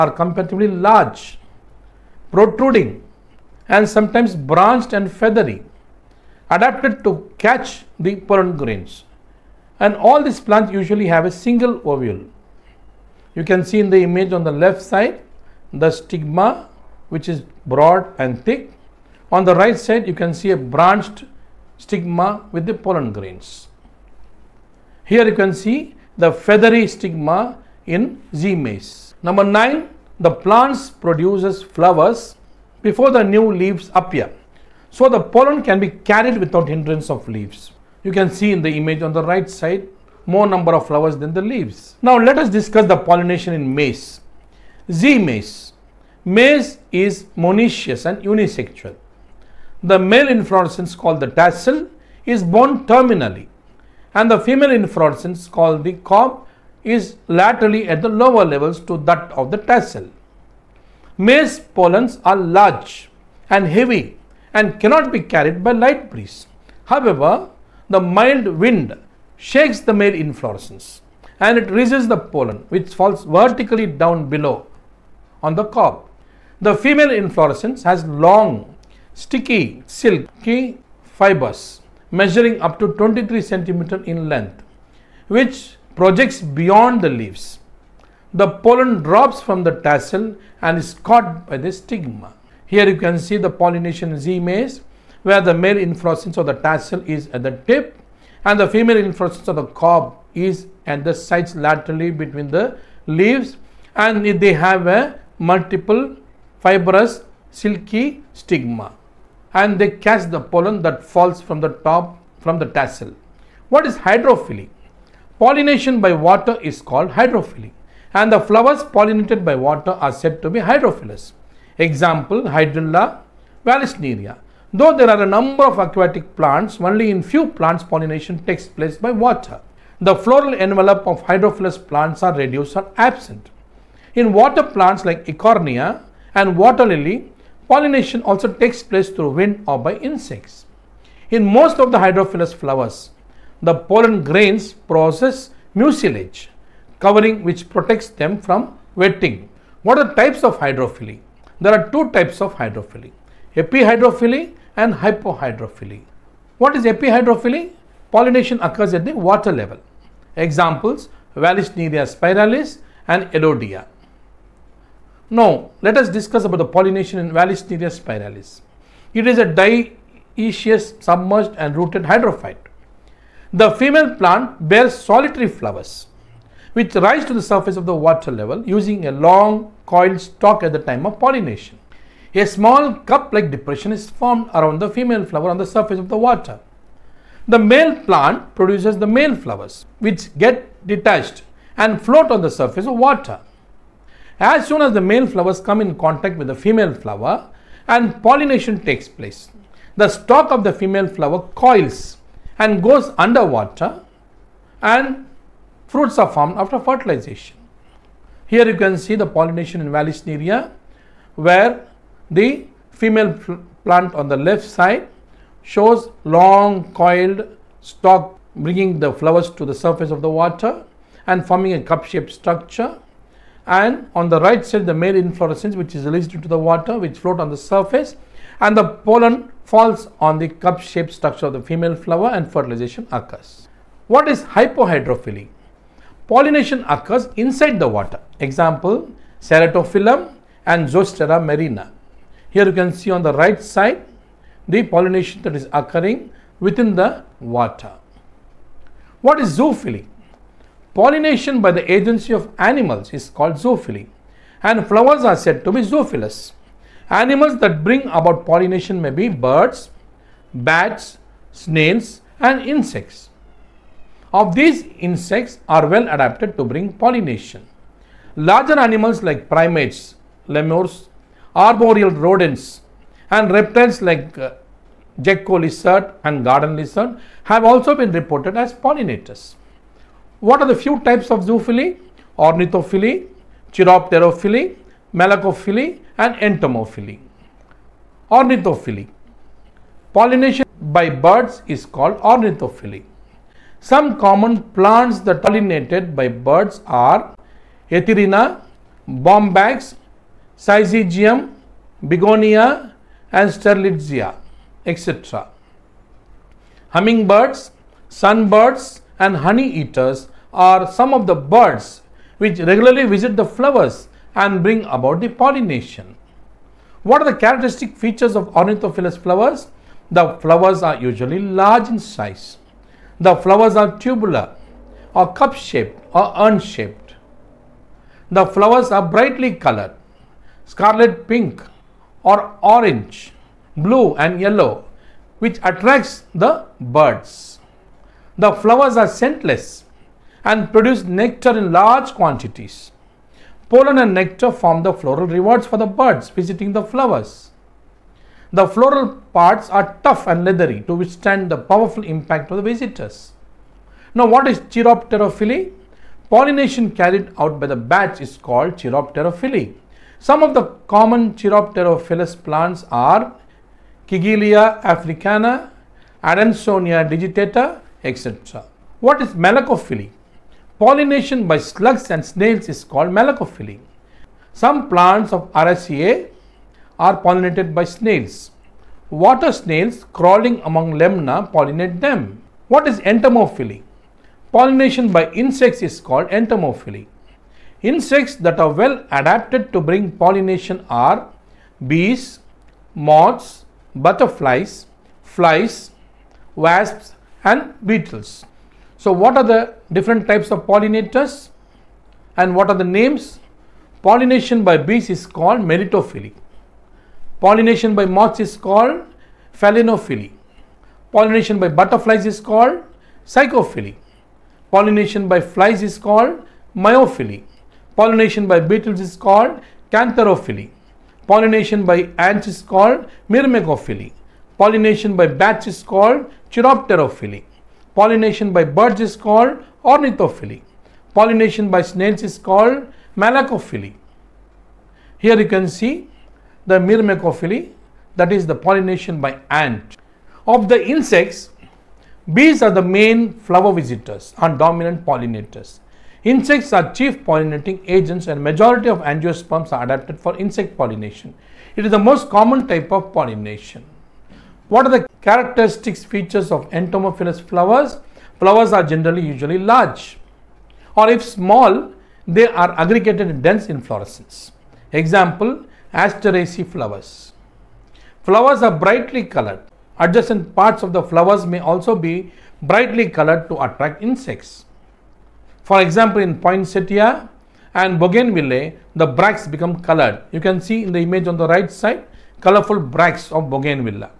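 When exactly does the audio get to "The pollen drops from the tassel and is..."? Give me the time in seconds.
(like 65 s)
88 s.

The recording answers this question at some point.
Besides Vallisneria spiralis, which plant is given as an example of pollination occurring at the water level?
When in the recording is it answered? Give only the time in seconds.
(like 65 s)
163 s.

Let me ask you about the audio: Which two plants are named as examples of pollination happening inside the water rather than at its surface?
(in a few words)
Ceratophyllum and Zostera marina.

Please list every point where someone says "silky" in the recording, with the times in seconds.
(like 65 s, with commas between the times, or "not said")
79 s, 107 s.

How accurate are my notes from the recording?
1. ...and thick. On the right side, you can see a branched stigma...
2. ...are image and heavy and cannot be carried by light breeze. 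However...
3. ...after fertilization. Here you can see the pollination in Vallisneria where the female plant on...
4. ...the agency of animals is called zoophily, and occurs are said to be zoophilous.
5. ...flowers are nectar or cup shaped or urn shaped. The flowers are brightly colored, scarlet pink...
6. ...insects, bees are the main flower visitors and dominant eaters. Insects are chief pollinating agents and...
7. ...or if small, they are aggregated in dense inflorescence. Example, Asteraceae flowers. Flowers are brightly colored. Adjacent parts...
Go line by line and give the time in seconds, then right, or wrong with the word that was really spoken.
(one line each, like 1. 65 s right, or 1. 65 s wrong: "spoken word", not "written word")
1. 18 s right
2. 62 s wrong: "large", not "image"
3. 206 s right
4. 251 s wrong: "flowers", not "occurs"
5. 323 s wrong: "tubular", not "nectar"
6. 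440 s wrong: "pollinators", not "eaters"
7. 460 s right.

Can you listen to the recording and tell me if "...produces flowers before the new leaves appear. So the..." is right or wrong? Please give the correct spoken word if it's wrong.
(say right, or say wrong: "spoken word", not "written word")
right.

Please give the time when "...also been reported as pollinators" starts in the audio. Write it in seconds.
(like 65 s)
277 s.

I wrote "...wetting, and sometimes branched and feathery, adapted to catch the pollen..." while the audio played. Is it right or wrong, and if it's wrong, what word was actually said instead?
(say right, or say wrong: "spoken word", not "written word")
wrong: "protruding", not "wetting".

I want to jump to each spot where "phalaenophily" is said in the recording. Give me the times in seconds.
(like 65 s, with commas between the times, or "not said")
409 s.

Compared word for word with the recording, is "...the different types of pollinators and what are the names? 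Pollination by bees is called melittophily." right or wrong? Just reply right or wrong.
right.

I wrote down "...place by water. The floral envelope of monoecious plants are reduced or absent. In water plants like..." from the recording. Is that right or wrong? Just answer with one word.
wrong.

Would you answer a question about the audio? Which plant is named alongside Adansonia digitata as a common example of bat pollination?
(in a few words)
Kigelia africana.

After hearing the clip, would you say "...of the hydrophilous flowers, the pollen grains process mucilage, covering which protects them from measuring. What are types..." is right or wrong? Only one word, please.
wrong.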